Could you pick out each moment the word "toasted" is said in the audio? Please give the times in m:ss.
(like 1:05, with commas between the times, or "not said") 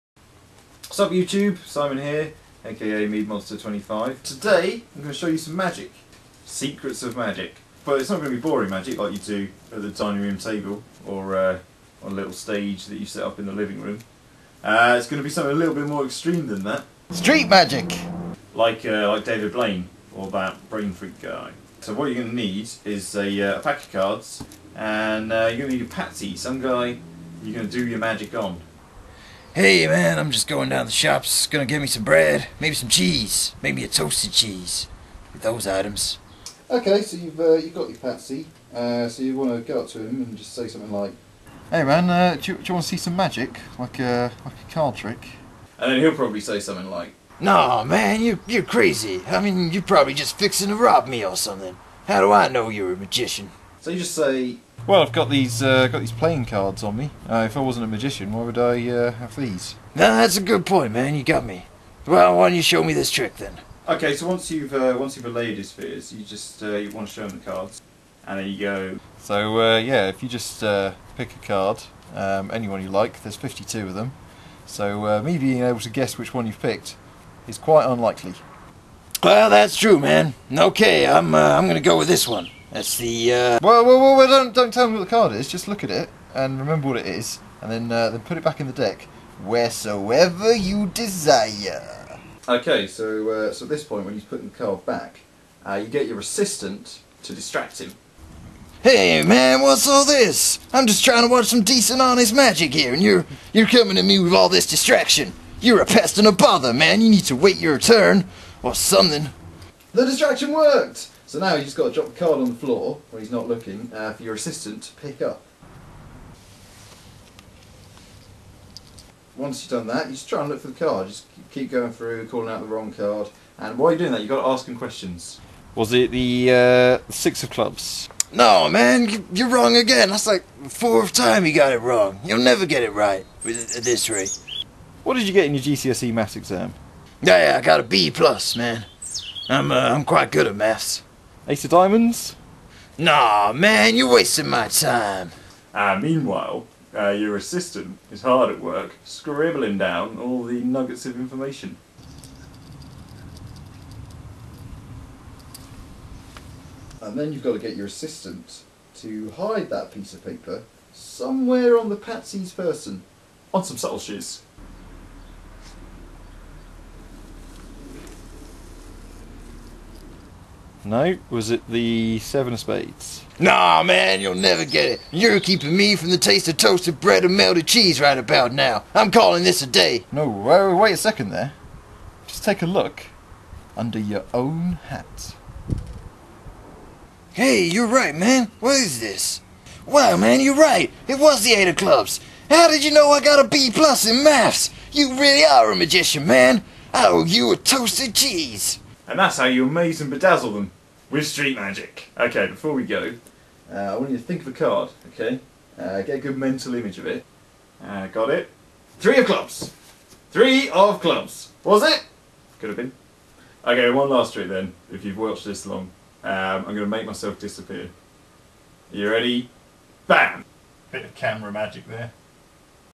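0:33, 2:56, 3:17.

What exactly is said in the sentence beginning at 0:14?
Uh, it's going to be something a little bit more extreme than that.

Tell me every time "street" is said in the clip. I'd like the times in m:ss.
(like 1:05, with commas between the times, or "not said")
0:17, 3:21.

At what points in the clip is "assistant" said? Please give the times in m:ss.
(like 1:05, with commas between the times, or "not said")
1:36, 1:54, 2:27, 2:37.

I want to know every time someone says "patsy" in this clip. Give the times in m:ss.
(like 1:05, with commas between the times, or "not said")
0:25, 0:37, 2:41.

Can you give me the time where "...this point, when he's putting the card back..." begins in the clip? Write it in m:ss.
1:33.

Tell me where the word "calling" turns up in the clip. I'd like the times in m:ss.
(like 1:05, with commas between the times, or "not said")
2:02, 2:59.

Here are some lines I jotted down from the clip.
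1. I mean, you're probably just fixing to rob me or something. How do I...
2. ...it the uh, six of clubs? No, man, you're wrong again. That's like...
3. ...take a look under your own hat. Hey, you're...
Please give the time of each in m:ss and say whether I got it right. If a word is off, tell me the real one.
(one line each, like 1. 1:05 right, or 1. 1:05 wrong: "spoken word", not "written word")
1. 0:49 right
2. 2:05 right
3. 3:02 right.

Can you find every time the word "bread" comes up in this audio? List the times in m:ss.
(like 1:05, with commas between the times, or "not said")
0:32, 2:56.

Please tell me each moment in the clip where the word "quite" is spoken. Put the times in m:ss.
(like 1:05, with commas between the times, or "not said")
1:17, 2:20.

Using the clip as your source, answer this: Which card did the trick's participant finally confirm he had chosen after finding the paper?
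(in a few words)
Eight of Clubs.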